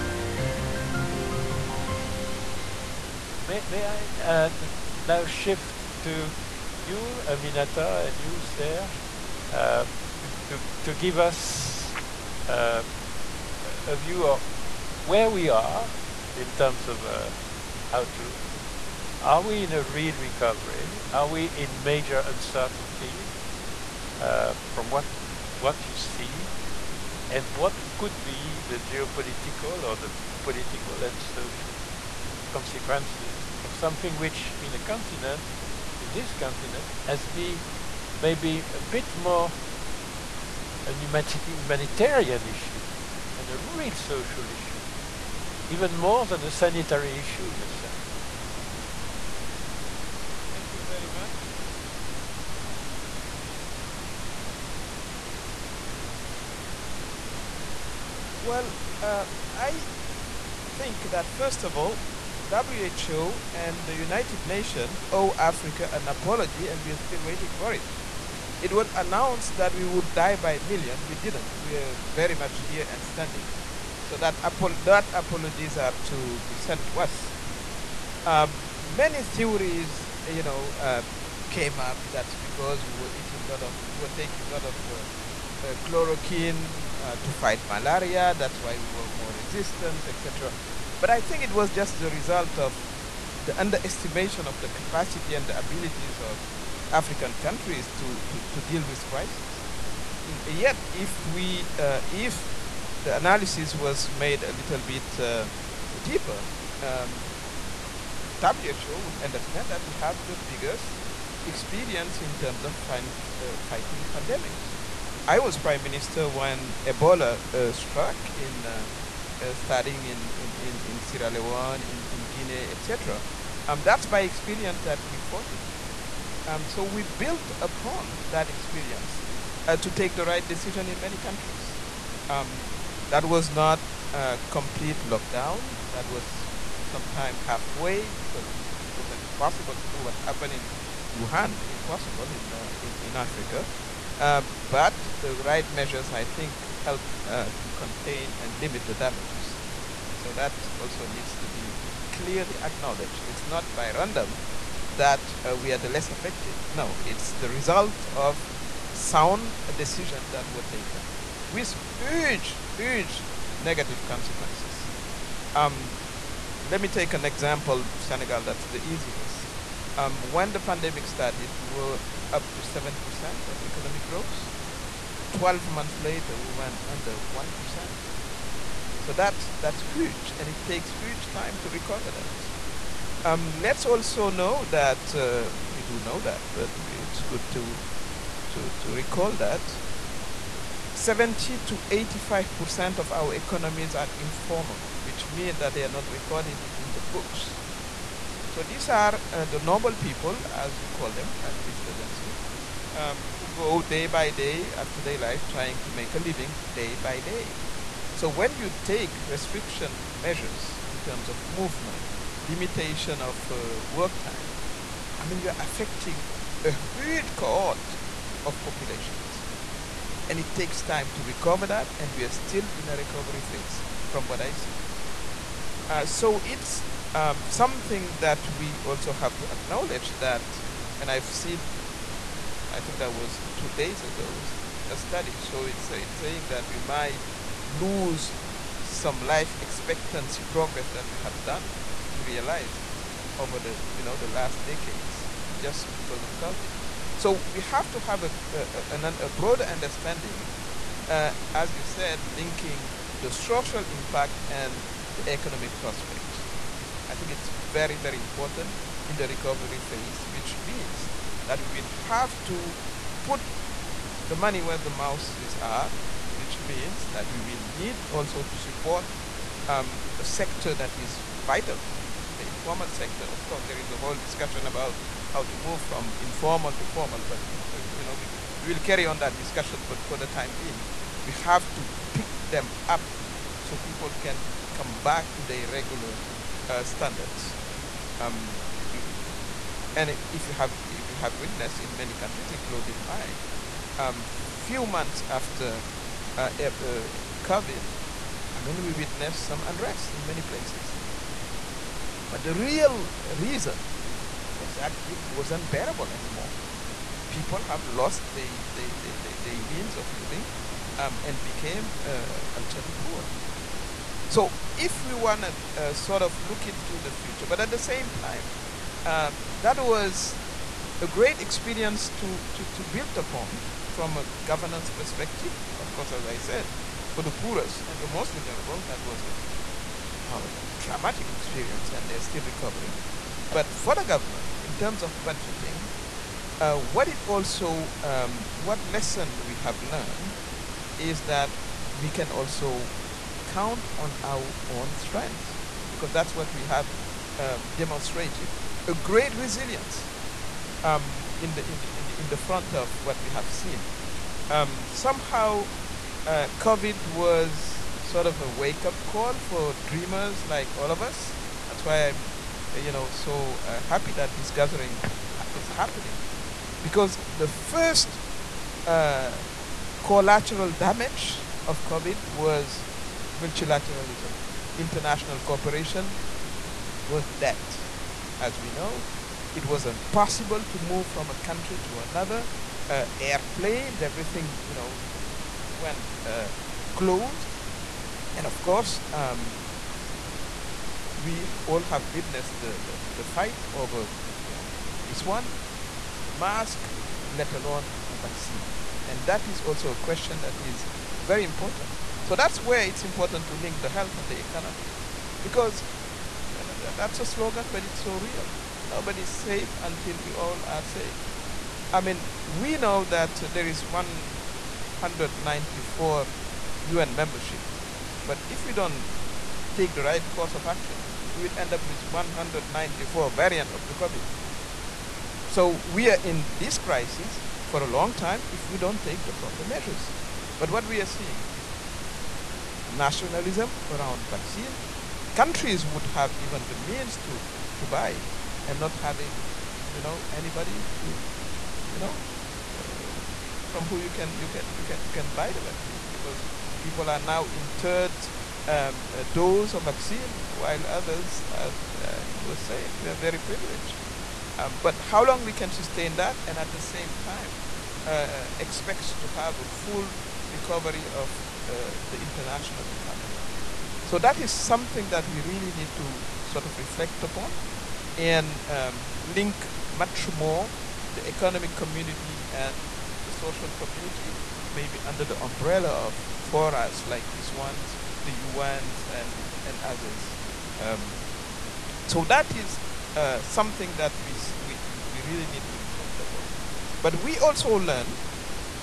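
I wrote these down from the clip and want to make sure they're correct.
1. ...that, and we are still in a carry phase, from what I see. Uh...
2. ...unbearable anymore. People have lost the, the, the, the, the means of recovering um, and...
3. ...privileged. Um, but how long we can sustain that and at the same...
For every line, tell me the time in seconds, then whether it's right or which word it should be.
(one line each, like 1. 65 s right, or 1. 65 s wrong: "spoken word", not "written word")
1. 221 s wrong: "recovery", not "carry"
2. 305 s wrong: "living", not "recovering"
3. 453 s right.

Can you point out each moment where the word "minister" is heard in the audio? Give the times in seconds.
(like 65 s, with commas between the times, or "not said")
115 s, 201 s.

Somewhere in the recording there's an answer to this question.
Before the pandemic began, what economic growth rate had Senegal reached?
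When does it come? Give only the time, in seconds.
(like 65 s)
172 s.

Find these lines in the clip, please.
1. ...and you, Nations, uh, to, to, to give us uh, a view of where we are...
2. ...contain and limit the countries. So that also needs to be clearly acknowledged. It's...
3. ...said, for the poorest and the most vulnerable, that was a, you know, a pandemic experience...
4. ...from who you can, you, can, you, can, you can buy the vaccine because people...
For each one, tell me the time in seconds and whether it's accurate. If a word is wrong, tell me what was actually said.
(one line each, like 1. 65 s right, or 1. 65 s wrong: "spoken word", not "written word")
1. 8 s wrong: "Serge", not "Nations"
2. 147 s wrong: "damages", not "countries"
3. 326 s wrong: "dramatic", not "pandemic"
4. 443 s right.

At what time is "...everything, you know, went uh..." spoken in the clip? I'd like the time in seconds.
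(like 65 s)
384 s.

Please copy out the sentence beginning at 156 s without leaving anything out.
No, it's the result of sound decisions that were taken with huge, huge negative consequences.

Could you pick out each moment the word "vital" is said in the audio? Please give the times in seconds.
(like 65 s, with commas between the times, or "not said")
271 s.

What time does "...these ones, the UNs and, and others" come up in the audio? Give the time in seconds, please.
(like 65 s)
477 s.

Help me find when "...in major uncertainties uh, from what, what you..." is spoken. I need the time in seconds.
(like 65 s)
21 s.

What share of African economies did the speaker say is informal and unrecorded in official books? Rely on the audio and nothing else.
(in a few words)
70 to 85%.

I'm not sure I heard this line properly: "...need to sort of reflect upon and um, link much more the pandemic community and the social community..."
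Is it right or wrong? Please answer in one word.
wrong.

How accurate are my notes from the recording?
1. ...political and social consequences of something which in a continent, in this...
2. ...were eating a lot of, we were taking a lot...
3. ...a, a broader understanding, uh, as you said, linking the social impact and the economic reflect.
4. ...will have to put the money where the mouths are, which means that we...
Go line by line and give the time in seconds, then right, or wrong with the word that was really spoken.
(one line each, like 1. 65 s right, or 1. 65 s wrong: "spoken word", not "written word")
1. 30 s right
2. 82 s right
3. 248 s wrong: "prospect", not "reflect"
4. 261 s right.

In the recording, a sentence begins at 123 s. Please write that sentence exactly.
Um, that's by experience that we fought it.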